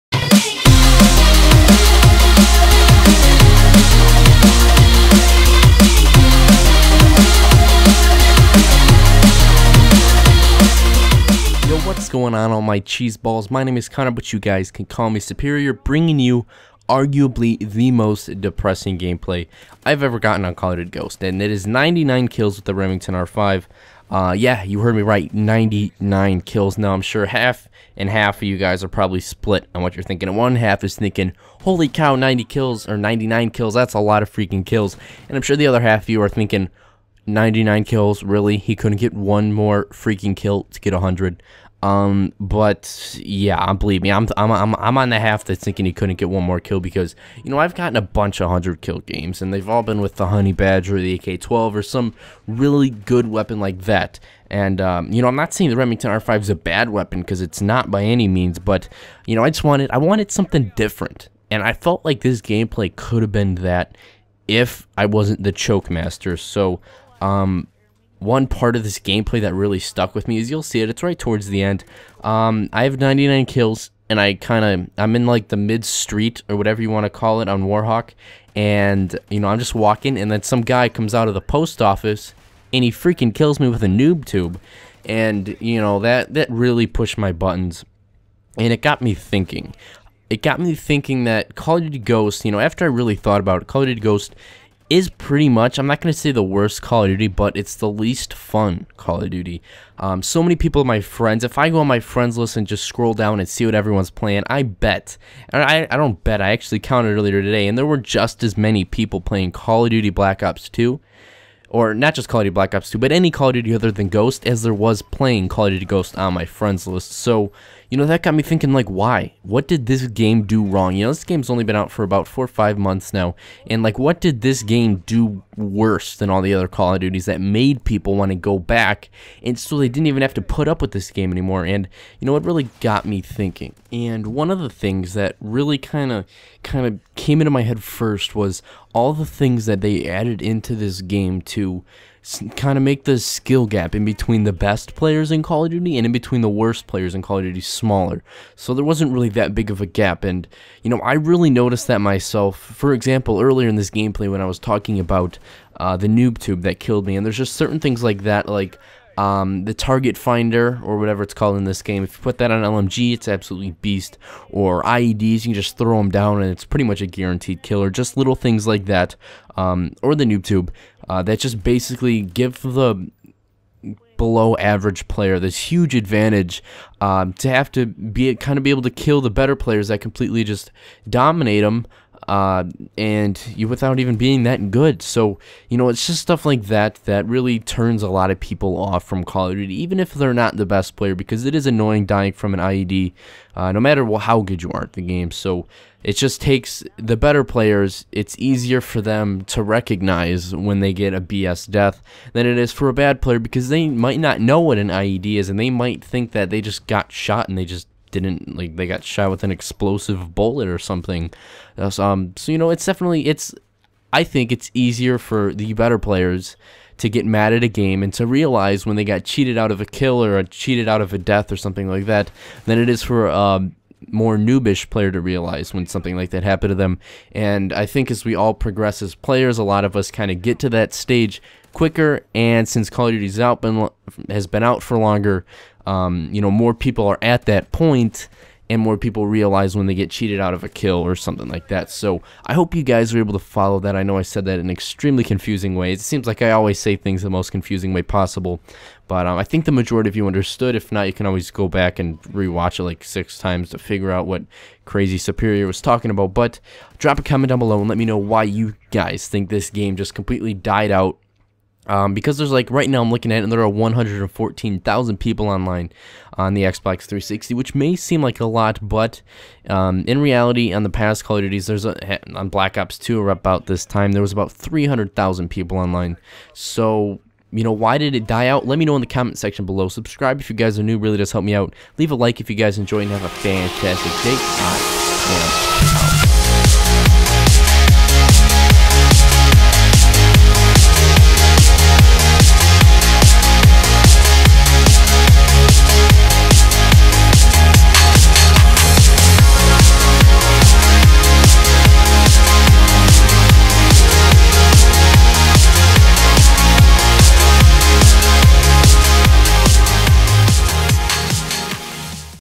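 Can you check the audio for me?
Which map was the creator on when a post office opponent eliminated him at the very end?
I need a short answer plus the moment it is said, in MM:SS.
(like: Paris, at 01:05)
Warhawk, at 01:17.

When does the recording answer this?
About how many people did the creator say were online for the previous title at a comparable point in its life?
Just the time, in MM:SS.
04:34.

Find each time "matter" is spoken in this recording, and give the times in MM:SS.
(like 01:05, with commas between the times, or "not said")
03:13.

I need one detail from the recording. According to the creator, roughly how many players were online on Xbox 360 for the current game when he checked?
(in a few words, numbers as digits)
114,000.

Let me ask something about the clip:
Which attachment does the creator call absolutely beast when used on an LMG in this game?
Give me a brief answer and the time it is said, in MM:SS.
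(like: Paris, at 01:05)
target finder, at 02:39.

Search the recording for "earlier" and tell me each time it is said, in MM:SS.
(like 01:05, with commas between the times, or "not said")
01:47, 02:33.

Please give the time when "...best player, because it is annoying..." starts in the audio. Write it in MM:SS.
03:10.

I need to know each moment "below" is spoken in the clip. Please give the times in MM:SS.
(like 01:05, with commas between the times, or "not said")
02:54, 04:17, 04:39.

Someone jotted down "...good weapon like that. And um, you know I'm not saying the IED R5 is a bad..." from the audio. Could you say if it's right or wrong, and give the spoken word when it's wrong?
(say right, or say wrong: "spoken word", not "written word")
wrong: "Remington", not "IED".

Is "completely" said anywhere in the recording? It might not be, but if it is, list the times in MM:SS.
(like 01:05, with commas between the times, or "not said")
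02:59, 04:20.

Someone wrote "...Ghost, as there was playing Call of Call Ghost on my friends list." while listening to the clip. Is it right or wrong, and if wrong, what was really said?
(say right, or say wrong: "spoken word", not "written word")
wrong: "Duty", not "Call".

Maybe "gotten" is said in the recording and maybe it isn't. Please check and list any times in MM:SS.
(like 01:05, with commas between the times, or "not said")
00:20, 00:47.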